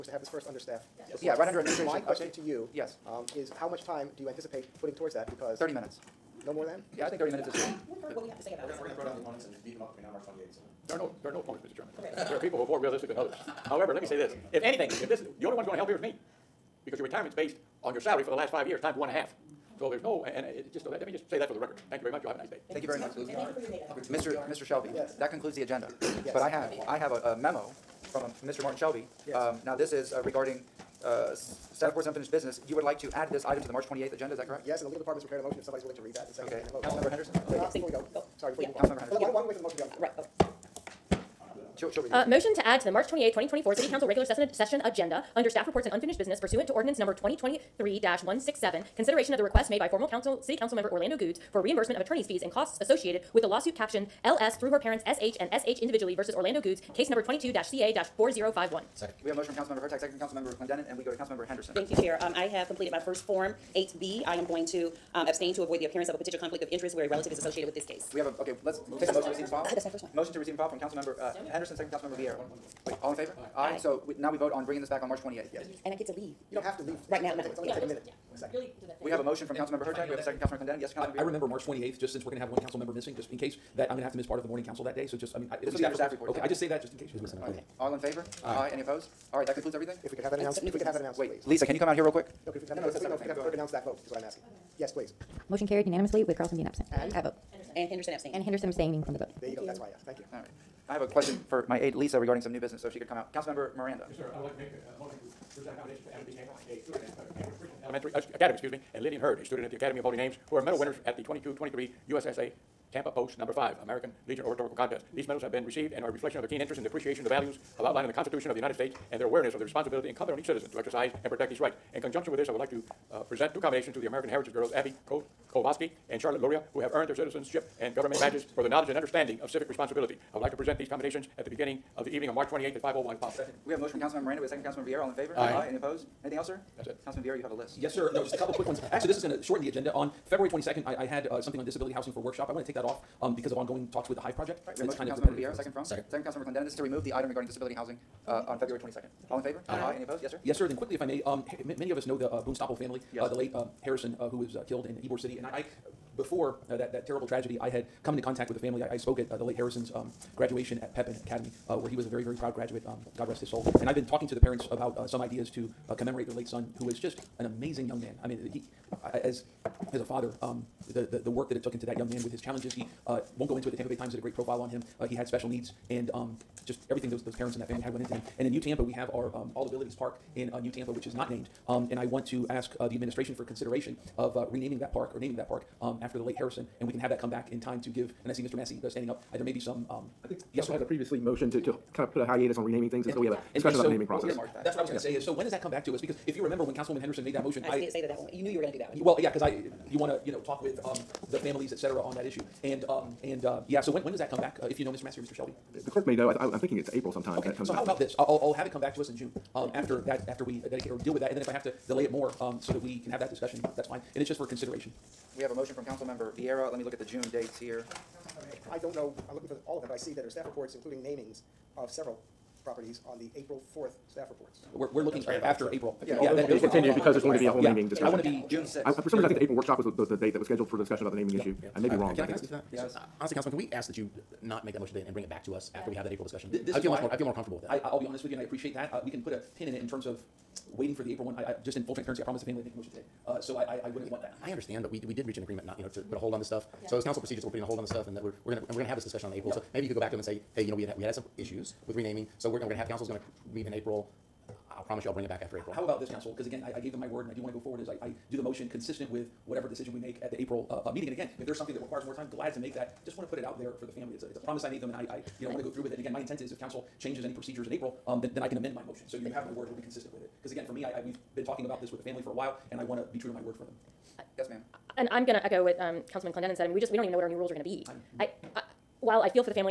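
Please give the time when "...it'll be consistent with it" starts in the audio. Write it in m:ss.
4:29.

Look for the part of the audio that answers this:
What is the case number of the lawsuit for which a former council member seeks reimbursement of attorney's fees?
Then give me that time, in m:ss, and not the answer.
0:57.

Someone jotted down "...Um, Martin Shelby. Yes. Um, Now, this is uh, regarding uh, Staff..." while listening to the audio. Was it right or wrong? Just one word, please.
right.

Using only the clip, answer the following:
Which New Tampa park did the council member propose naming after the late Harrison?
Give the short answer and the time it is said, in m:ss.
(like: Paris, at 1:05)
All Abilities Park, at 2:59.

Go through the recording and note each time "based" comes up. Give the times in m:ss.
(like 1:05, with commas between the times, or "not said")
0:17.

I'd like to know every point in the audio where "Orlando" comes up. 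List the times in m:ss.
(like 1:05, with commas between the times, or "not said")
0:50, 0:56.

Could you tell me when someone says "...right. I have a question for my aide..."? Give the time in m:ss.
1:40.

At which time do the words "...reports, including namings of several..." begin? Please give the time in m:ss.
3:40.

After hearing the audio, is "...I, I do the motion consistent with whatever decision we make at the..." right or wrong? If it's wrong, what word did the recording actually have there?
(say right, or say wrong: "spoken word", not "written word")
right.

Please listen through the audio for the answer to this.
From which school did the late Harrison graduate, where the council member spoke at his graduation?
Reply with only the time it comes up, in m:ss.
2:40.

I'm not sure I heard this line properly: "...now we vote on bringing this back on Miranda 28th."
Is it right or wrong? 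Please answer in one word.
wrong.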